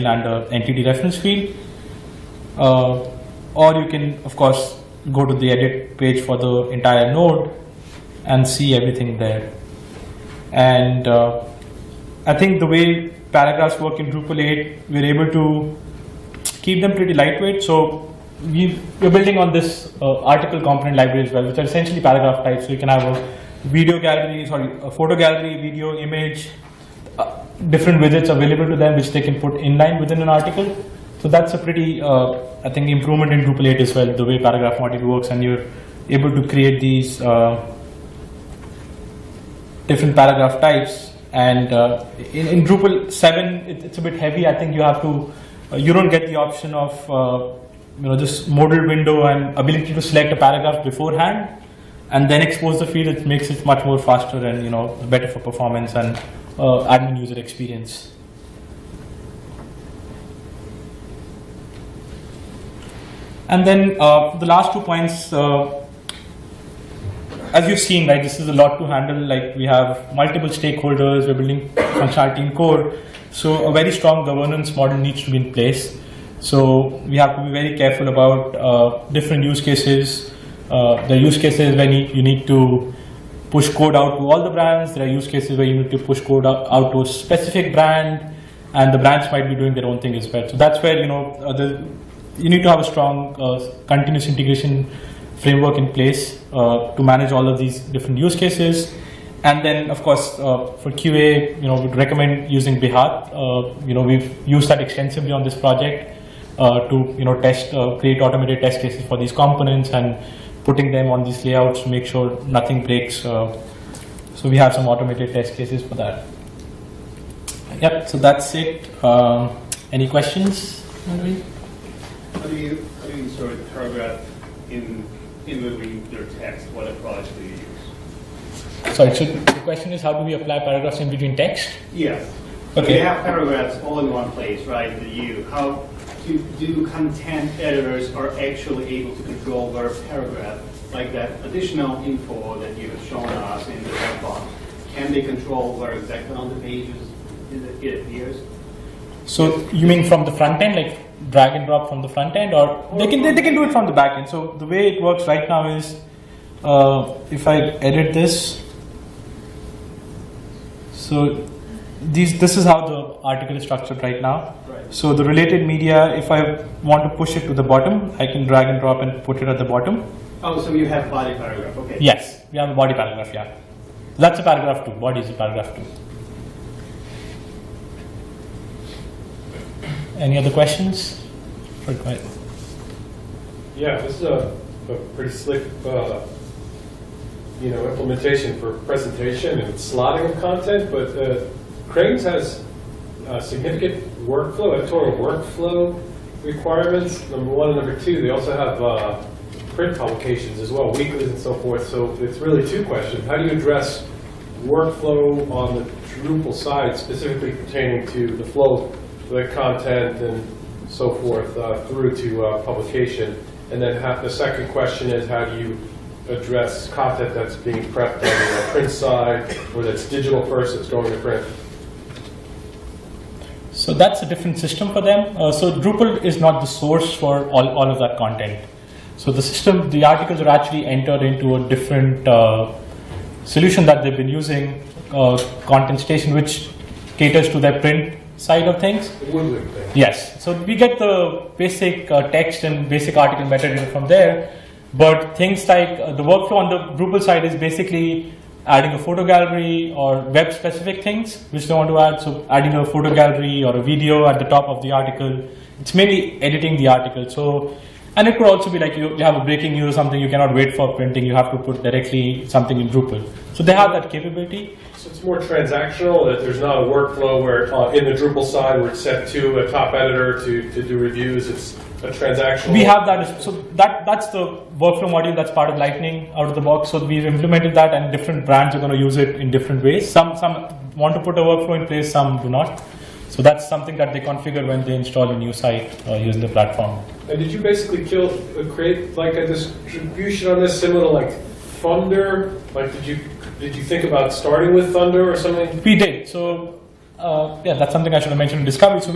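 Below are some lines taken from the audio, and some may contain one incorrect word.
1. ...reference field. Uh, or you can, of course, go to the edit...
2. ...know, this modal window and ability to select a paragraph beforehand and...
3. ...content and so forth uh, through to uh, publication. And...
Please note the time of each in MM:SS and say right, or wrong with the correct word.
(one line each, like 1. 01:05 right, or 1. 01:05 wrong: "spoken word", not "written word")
1. 00:00 right
2. 00:48 right
3. 03:29 right.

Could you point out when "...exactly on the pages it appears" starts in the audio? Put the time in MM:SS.
02:25.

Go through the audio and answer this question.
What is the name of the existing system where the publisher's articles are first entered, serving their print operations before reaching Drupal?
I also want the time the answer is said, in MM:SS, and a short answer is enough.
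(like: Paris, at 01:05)
Content Station, at 03:55.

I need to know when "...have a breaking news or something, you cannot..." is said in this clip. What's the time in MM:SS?
04:19.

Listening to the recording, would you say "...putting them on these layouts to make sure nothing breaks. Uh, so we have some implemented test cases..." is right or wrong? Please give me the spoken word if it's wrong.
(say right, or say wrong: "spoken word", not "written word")
wrong: "automated", not "implemented".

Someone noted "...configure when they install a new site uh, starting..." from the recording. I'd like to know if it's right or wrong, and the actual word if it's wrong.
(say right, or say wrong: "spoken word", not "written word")
wrong: "using", not "starting".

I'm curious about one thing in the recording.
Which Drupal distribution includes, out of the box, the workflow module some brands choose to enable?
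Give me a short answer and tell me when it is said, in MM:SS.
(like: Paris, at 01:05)
Lightning, at 04:35.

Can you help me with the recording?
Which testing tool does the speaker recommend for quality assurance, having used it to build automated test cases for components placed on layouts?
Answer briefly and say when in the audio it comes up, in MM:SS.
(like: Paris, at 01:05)
Behat, at 01:42.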